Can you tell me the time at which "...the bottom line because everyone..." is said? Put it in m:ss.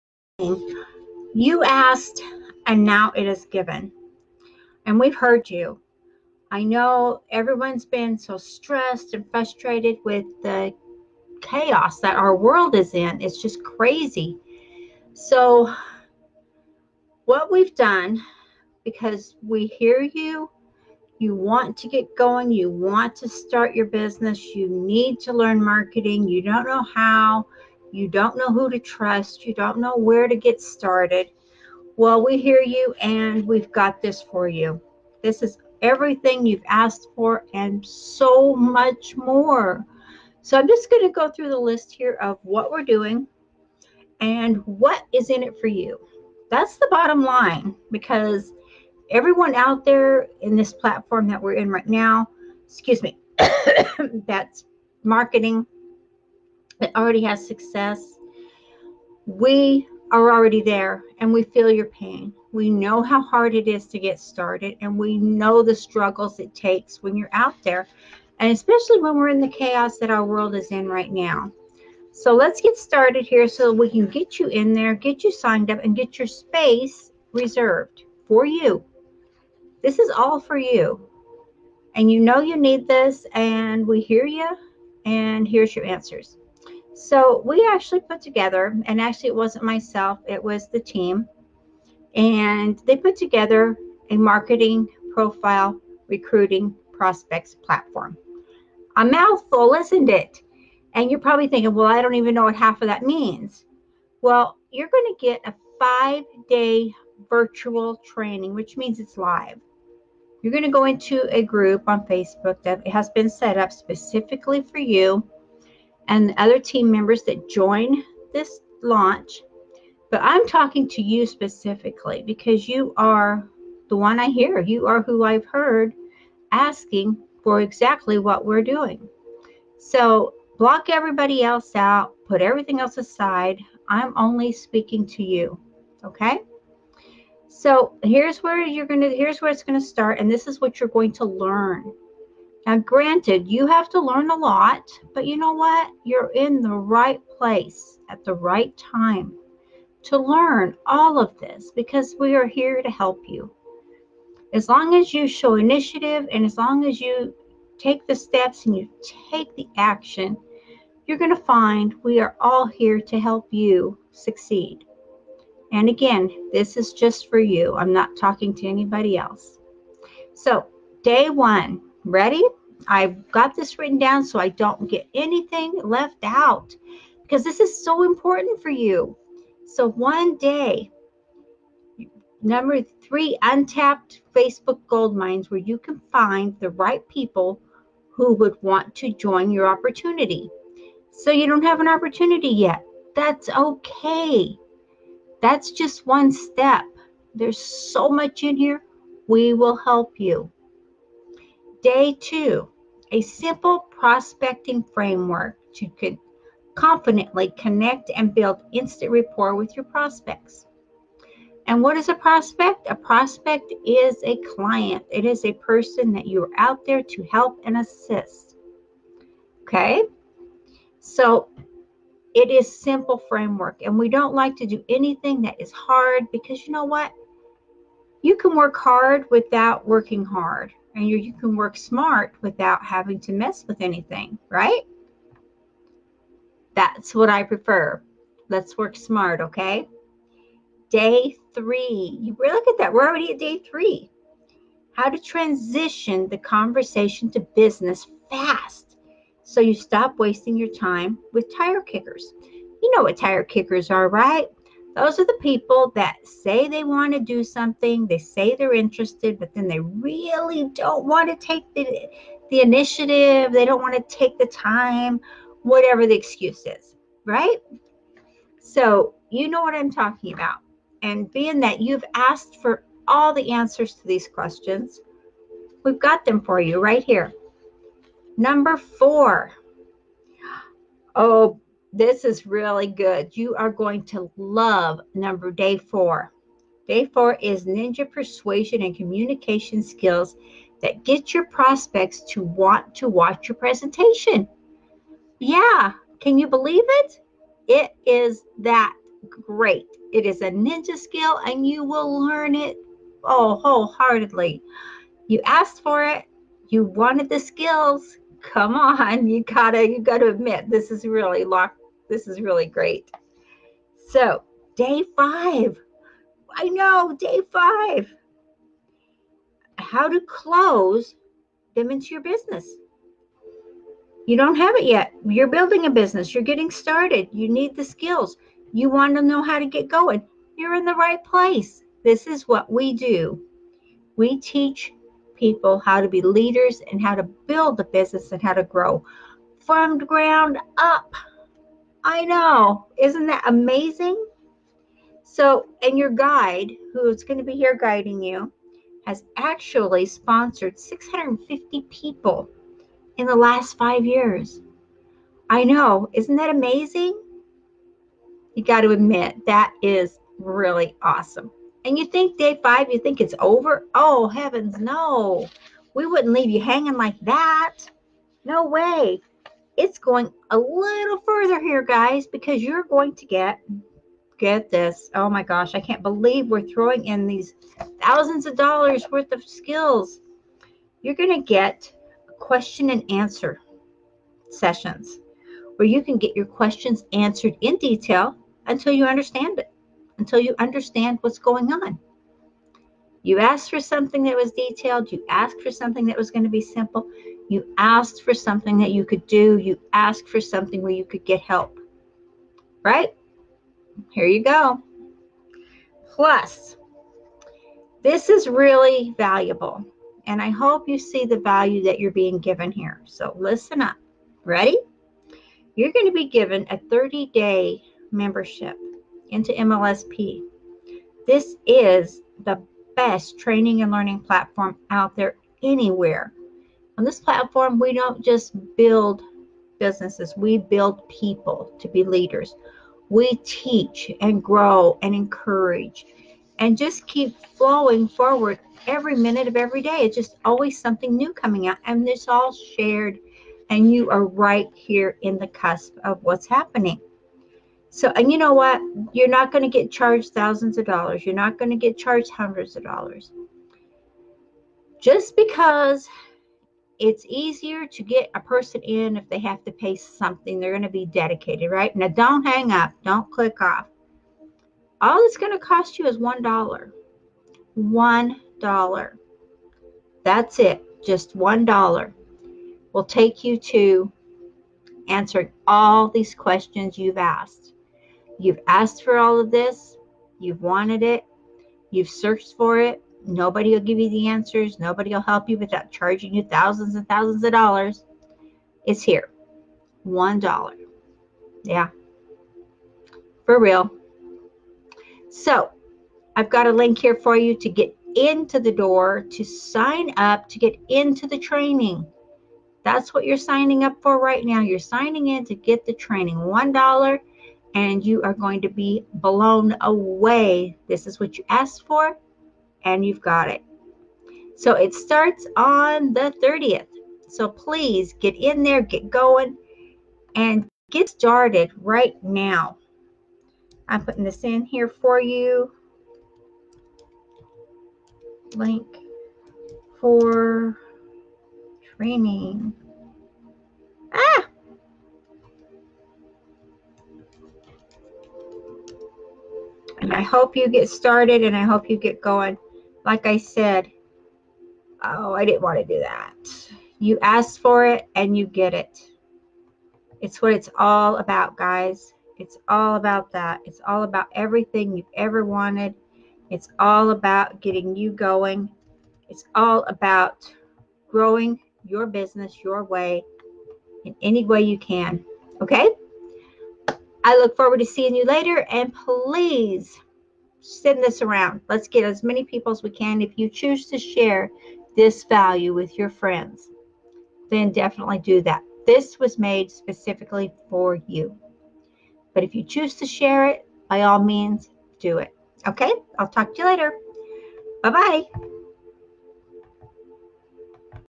0:46.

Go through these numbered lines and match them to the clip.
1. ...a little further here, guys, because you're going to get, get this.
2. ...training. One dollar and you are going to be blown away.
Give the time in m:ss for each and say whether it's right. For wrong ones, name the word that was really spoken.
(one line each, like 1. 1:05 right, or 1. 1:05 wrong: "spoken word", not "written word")
1. 6:10 right
2. 8:25 right.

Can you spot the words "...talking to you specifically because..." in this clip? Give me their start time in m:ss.
2:00.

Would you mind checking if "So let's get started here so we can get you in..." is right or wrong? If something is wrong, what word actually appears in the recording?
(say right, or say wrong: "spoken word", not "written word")
right.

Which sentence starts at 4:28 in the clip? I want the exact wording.
So, you know what I'm talking about.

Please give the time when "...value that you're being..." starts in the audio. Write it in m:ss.
6:51.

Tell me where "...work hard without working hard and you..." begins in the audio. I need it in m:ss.
3:48.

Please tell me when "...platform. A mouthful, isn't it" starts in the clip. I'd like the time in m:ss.
1:37.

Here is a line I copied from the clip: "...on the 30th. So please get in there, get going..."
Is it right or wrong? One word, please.
right.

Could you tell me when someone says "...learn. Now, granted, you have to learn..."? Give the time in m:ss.
2:21.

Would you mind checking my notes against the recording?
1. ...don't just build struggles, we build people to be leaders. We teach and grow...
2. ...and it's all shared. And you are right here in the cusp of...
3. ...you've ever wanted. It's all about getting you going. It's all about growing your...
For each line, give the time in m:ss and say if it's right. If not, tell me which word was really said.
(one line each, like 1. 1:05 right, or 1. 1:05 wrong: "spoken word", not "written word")
1. 7:07 wrong: "businesses", not "struggles"
2. 7:21 right
3. 9:14 right.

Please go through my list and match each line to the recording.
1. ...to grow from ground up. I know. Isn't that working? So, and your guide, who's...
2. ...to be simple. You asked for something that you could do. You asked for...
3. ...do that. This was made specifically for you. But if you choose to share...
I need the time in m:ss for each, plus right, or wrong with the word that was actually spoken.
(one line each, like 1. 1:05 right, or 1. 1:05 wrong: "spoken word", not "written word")
1. 5:38 wrong: "amazing", not "working"
2. 6:36 right
3. 9:38 right.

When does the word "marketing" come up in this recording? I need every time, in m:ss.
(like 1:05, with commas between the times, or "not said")
0:25, 0:55, 1:34.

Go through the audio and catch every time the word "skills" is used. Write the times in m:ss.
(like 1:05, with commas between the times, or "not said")
4:49, 5:00, 5:07, 5:27, 6:19.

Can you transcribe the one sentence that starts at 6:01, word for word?
And you think day five, you think it's over?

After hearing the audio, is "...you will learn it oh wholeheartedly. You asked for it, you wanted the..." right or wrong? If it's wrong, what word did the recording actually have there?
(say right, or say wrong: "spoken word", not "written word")
right.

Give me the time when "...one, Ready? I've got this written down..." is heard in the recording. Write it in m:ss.
2:51.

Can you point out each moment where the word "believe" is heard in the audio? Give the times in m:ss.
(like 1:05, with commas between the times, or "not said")
4:56, 6:16.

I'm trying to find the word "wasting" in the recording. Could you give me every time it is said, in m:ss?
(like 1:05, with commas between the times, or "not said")
4:10.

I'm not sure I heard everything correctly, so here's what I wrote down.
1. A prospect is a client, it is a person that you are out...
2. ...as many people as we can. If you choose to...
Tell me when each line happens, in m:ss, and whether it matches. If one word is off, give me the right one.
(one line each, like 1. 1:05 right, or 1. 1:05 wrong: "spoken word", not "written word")
1. 3:32 right
2. 9:32 right.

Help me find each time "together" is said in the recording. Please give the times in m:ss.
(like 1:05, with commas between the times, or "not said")
1:28, 1:33.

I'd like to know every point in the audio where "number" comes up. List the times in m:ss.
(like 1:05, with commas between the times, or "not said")
3:02, 4:38, 4:45.